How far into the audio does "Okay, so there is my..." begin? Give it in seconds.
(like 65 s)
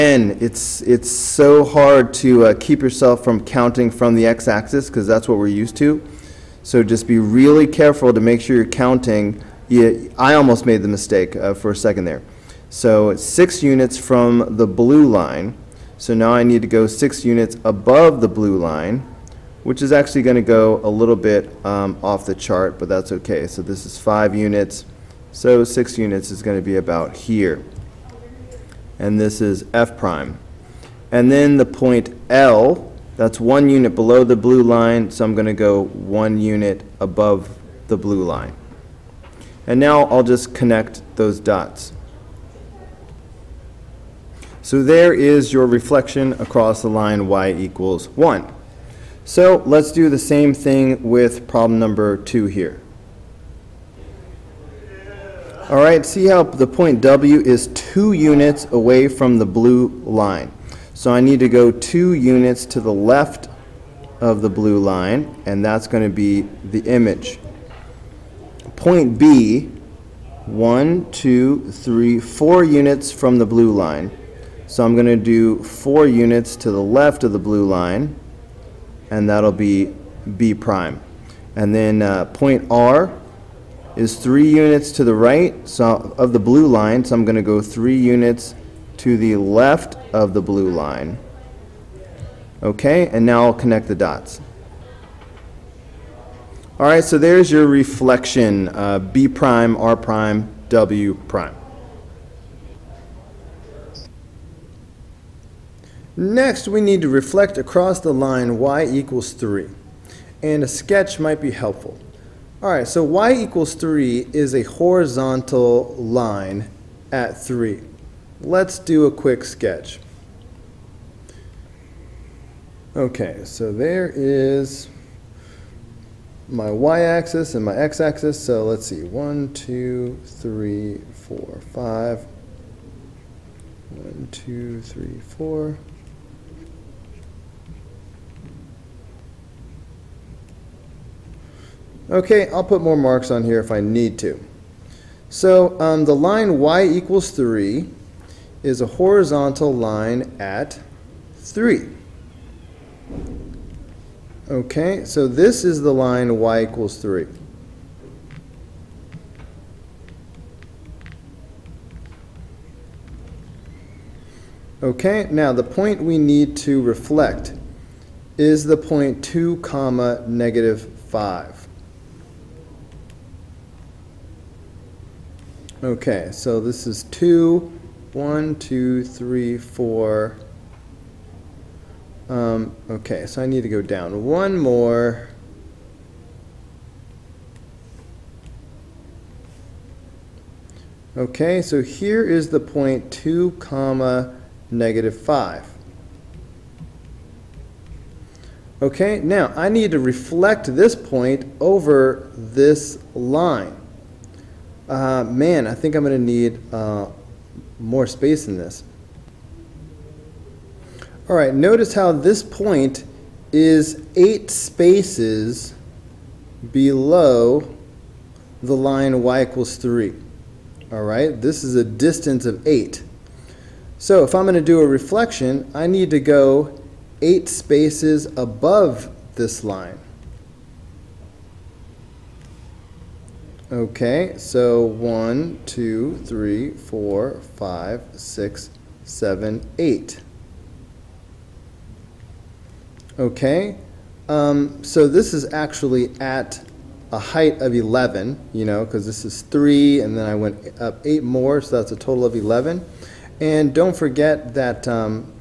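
122 s.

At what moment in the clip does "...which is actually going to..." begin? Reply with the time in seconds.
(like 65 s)
19 s.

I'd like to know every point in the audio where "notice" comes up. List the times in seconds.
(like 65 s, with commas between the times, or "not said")
211 s.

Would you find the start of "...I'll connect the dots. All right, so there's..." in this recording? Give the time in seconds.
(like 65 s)
93 s.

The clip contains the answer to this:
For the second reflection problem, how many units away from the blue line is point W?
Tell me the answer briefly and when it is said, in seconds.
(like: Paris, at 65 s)
2, at 57 s.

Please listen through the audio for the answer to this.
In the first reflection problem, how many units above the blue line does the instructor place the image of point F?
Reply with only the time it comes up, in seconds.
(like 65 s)
25 s.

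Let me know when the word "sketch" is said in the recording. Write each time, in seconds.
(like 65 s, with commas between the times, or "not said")
110 s, 119 s.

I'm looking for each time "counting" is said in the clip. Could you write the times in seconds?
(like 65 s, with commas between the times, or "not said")
3 s, 8 s.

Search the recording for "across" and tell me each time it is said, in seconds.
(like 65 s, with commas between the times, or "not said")
46 s, 107 s.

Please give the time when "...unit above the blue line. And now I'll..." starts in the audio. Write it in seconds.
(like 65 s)
36 s.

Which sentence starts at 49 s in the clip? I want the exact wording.
So let's do the same thing with problem number 2 here.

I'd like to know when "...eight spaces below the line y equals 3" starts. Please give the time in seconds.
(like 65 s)
214 s.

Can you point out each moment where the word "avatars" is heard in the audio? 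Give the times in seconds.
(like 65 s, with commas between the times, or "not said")
not said.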